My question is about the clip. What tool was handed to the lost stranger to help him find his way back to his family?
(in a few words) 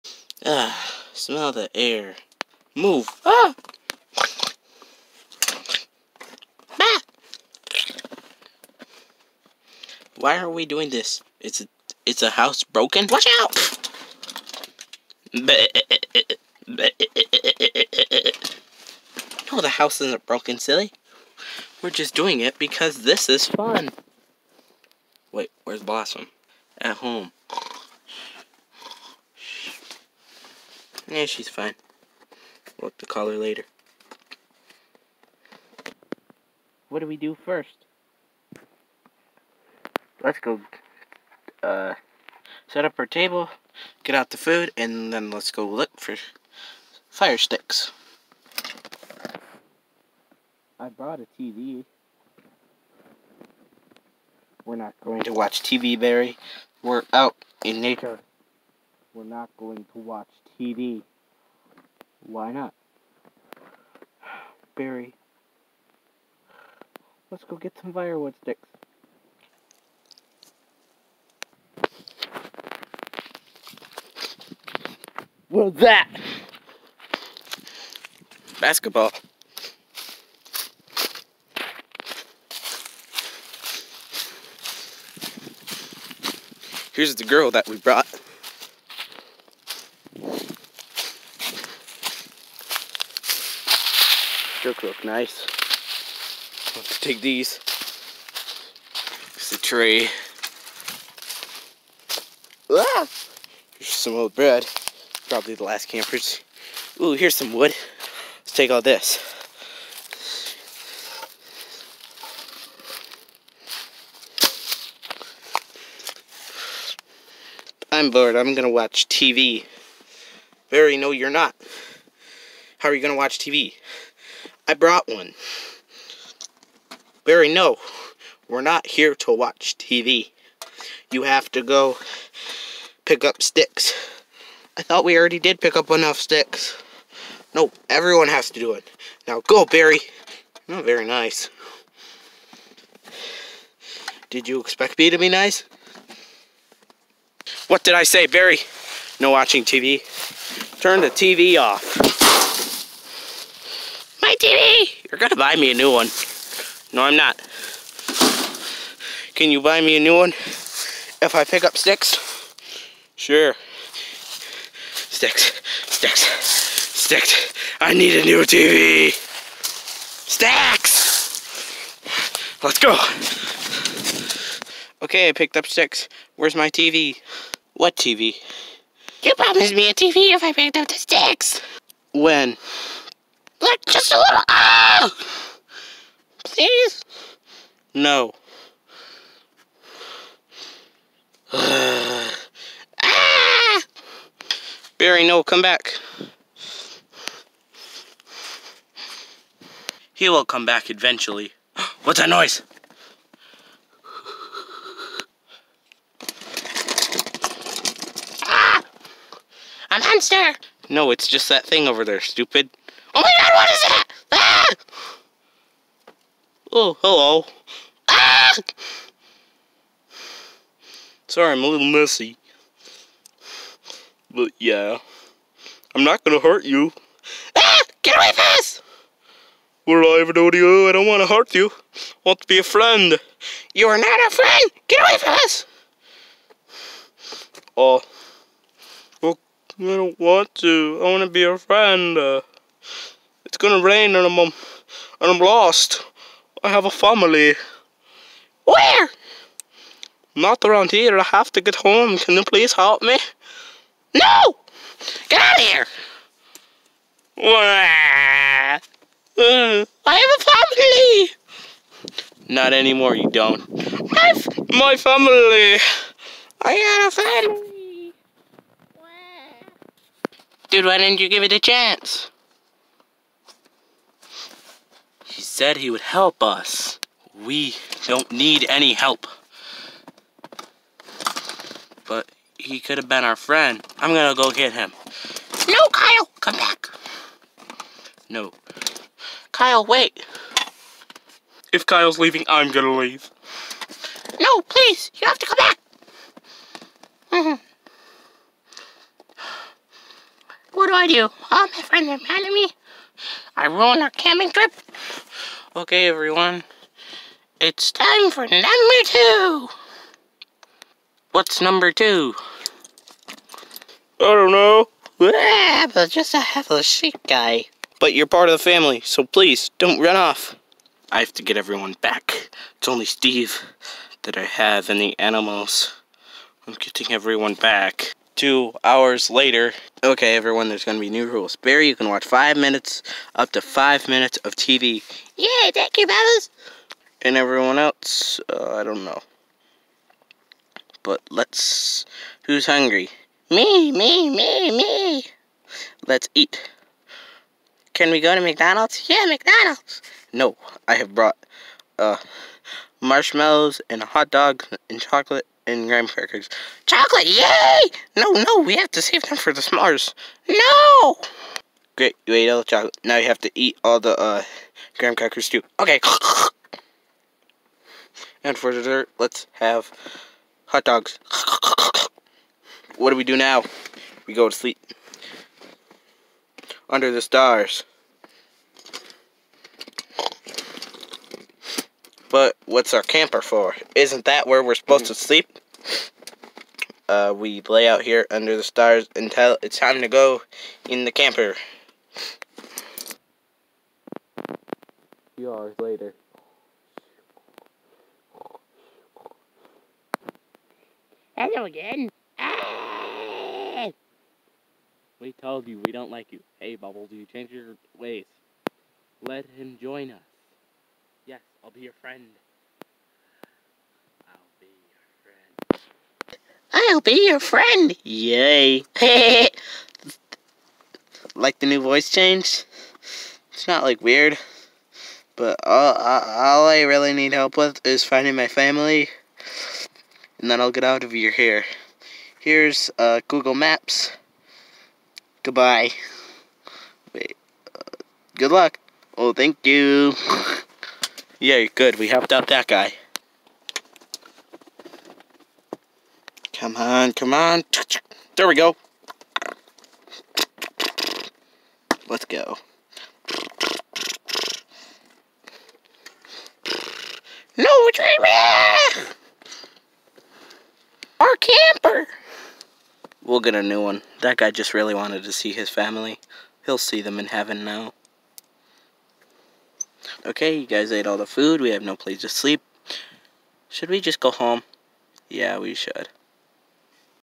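Google Maps.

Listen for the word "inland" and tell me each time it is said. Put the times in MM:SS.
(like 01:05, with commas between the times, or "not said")
not said.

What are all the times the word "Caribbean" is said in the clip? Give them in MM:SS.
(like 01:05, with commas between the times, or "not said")
not said.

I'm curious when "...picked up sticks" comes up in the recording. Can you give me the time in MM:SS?
02:55.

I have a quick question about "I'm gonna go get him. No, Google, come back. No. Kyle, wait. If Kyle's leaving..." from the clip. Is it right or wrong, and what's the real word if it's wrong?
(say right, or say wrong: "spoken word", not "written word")
wrong: "Kyle", not "Google".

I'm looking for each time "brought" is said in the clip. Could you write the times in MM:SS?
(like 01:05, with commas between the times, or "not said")
00:50, 01:27, 02:04, 05:51.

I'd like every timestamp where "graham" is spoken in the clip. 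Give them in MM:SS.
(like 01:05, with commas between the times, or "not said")
05:55, 06:04.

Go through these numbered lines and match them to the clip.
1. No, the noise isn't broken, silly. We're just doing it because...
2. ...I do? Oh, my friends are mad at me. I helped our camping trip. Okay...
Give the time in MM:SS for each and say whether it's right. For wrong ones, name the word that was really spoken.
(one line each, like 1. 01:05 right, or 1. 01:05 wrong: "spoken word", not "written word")
1. 00:15 wrong: "house", not "noise"
2. 05:00 wrong: "ruined", not "helped".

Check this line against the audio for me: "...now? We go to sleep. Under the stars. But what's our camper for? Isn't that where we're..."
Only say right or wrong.
right.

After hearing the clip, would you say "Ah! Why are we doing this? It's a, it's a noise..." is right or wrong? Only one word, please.
wrong.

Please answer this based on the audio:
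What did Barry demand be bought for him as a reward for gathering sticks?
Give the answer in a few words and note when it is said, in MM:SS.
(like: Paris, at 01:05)
A new TV, at 02:48.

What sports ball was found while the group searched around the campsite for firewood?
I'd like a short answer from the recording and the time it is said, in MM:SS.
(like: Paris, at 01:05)
Basketball, at 01:18.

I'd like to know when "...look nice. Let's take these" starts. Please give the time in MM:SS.
01:34.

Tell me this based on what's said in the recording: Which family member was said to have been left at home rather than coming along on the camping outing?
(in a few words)
Blossom.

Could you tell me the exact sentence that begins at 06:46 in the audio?
Hey, Bubbles, you change your ways.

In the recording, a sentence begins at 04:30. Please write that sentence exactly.
Dude, why didn't you give it a chance?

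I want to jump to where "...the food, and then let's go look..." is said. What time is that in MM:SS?
00:44.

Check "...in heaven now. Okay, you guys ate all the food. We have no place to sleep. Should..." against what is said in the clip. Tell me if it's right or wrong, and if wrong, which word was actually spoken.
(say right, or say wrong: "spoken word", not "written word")
right.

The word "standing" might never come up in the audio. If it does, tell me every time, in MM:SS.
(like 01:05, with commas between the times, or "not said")
not said.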